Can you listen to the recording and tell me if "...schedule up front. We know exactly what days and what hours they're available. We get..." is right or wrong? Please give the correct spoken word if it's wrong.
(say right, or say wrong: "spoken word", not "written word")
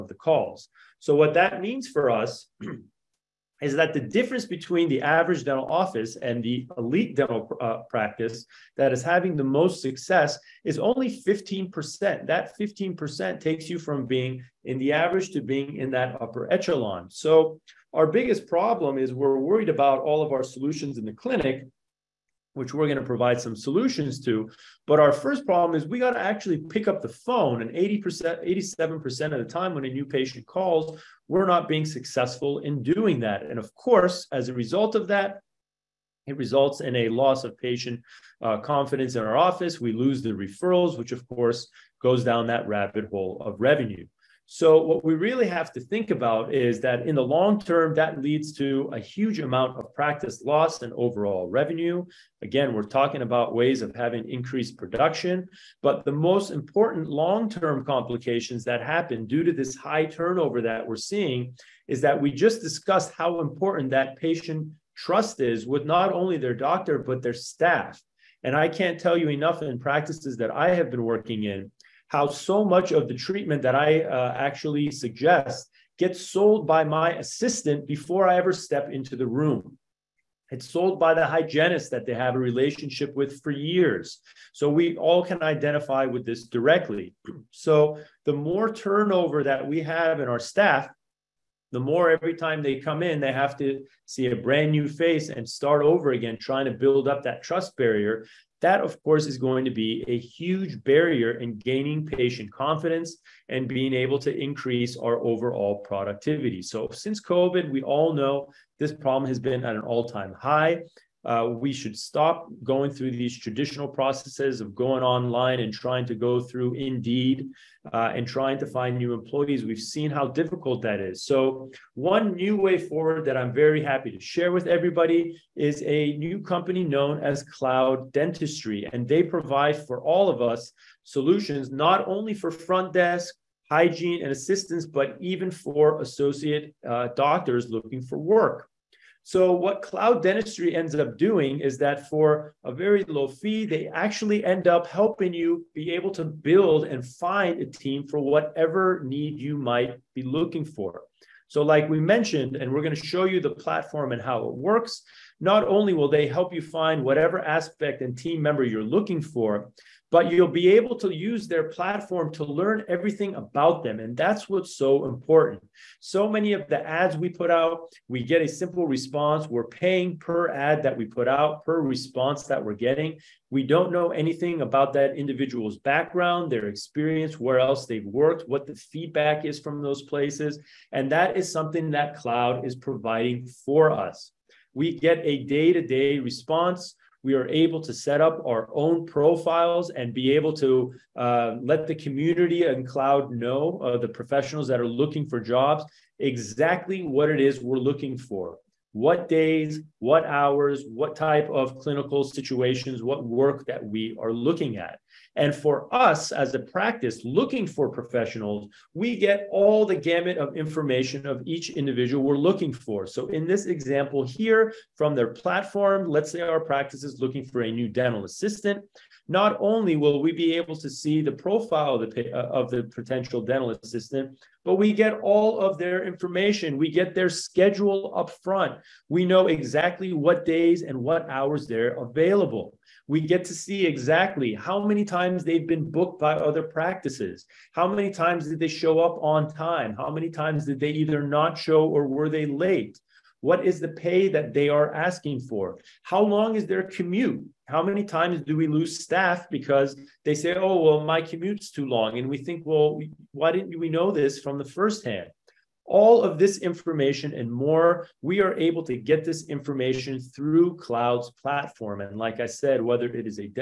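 right.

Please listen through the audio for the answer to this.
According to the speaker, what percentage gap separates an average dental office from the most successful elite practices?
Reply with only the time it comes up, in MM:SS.
00:10.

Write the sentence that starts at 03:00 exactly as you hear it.
And that is something that cloud is providing for us.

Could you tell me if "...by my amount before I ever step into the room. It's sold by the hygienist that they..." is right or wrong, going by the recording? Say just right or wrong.
wrong.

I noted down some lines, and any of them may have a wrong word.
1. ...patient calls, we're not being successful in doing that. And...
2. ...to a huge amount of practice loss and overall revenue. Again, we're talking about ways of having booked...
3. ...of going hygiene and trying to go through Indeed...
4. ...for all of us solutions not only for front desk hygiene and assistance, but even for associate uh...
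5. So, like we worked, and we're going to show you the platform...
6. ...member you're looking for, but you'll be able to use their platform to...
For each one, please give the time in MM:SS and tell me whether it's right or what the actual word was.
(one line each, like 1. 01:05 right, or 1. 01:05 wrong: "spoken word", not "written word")
1. 00:30 right
2. 00:48 wrong: "increased", not "booked"
3. 01:54 wrong: "online", not "hygiene"
4. 02:09 right
5. 02:31 wrong: "mentioned", not "worked"
6. 02:38 right.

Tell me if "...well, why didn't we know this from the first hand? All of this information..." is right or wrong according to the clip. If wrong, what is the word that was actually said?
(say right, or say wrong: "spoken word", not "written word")
right.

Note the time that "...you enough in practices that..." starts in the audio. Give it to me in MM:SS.
01:09.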